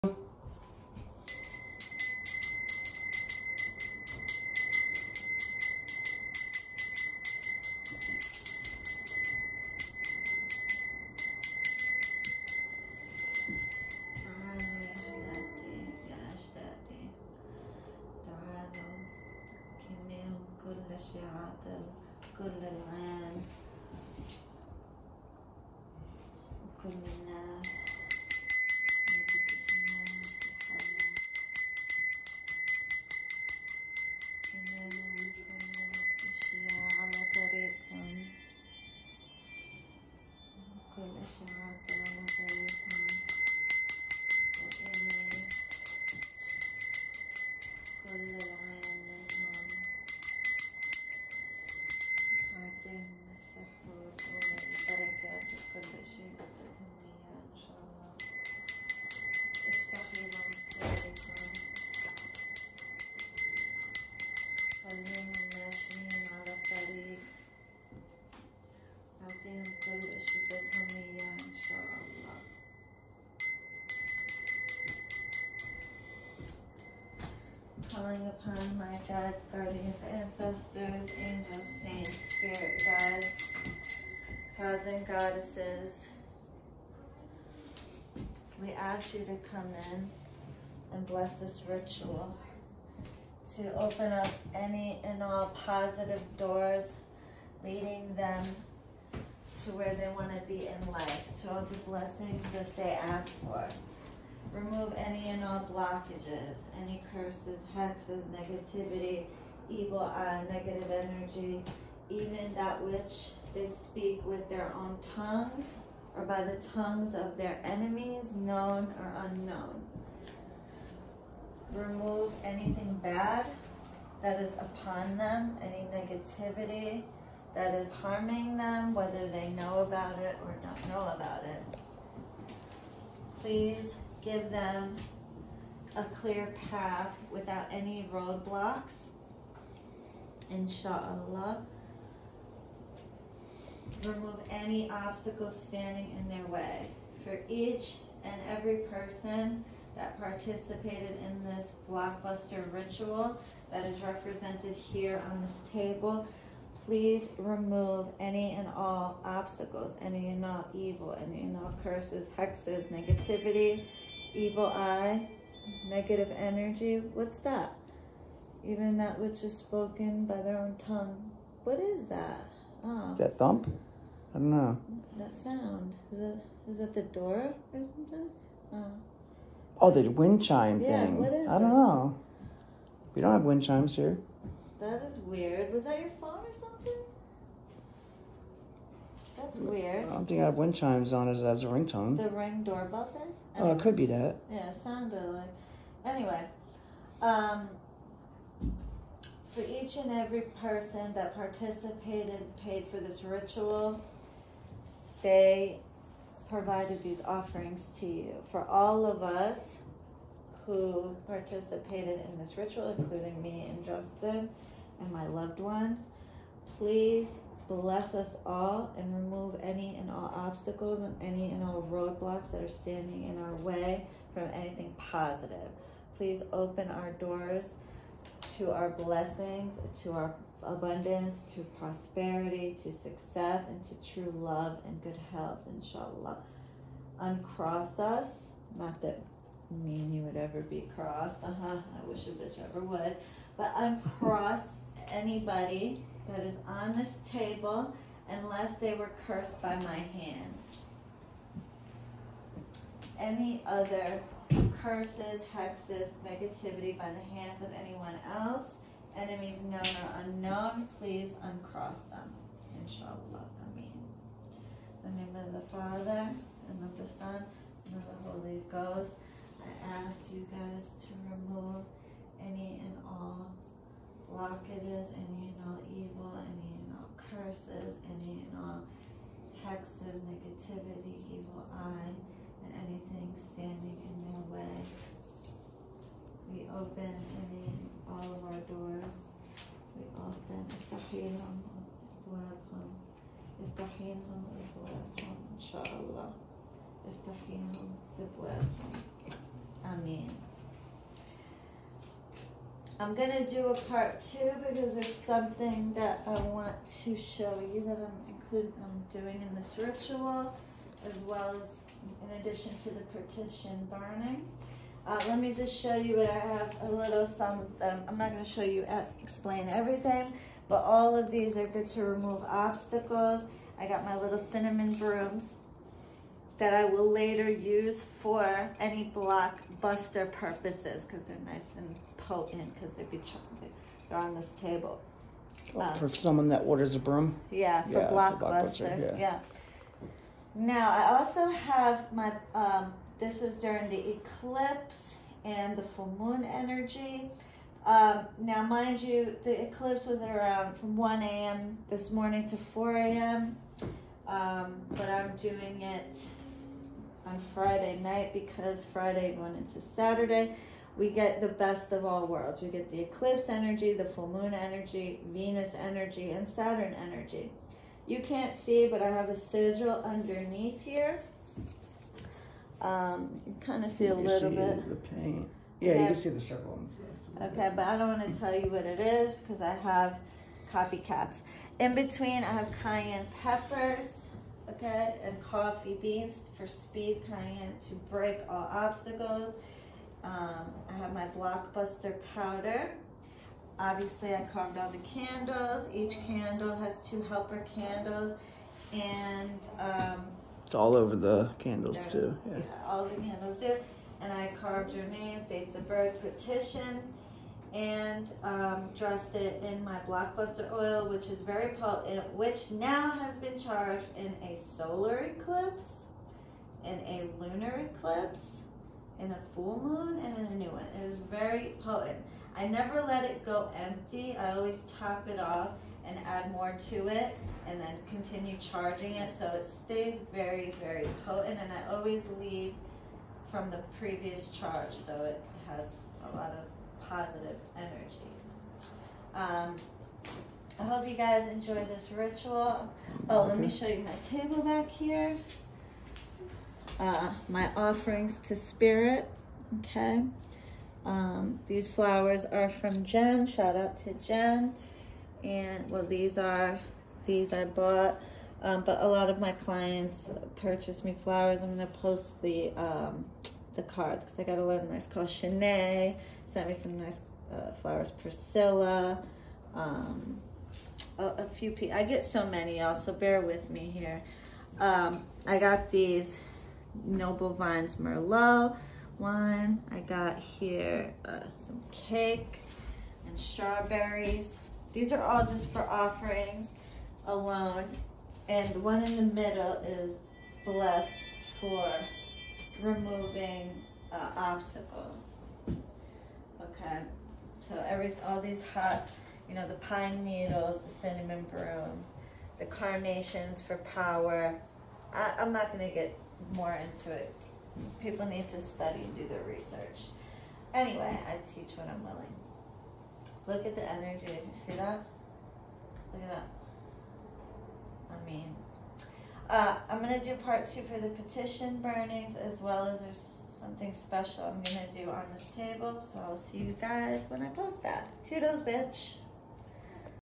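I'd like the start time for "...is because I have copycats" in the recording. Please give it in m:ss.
6:18.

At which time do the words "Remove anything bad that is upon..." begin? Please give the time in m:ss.
2:01.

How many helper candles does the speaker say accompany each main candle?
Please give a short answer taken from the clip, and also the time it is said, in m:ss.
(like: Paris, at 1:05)
2, at 6:37.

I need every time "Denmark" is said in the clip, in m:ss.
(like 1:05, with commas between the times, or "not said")
not said.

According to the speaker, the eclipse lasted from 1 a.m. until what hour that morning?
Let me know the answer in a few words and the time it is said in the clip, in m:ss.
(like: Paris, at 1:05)
4 a.m., at 5:52.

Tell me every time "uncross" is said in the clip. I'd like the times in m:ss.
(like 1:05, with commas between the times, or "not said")
3:57, 4:03, 4:21.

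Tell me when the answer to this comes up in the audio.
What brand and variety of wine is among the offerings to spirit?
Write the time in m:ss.
7:57.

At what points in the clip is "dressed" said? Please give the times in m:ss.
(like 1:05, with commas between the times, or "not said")
6:48.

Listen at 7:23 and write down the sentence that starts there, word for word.
Oh, let me show you my table back here.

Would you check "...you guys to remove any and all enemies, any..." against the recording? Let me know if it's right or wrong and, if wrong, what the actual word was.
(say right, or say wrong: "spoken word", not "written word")
wrong: "blockages", not "enemies".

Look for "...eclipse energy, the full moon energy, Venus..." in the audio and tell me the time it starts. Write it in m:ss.
6:03.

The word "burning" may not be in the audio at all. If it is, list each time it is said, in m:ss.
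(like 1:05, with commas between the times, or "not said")
5:13, 8:41.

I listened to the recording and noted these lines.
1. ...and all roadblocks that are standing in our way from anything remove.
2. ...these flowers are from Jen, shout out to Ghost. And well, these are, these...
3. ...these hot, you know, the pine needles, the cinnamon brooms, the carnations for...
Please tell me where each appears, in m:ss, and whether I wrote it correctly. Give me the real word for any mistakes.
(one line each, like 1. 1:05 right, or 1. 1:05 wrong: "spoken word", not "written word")
1. 3:41 wrong: "positive", not "remove"
2. 7:31 wrong: "Jen", not "Ghost"
3. 8:18 right.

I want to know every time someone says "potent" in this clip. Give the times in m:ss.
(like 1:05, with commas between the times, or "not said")
5:32, 6:51, 7:01, 7:11.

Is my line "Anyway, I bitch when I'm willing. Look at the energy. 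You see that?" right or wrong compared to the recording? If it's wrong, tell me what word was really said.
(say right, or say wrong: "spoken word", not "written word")
wrong: "teach", not "bitch".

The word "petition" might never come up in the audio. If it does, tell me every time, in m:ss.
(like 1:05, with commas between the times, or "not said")
5:13, 6:46, 8:41.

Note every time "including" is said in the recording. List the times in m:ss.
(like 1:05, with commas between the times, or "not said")
3:32, 5:08.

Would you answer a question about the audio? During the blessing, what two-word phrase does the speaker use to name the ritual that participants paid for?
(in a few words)
blockbuster ritual.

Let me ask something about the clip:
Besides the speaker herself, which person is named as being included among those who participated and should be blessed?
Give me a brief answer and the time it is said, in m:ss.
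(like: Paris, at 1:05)
Justin, at 3:33.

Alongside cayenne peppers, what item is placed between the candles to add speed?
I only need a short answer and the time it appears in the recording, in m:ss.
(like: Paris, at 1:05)
coffee beans, at 6:25.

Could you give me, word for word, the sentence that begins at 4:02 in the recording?
I wish a bitch ever would.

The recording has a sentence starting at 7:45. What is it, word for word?
Shanae sent me some nice uh, flowers.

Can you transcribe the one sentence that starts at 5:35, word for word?
um, for someone that orders a broom?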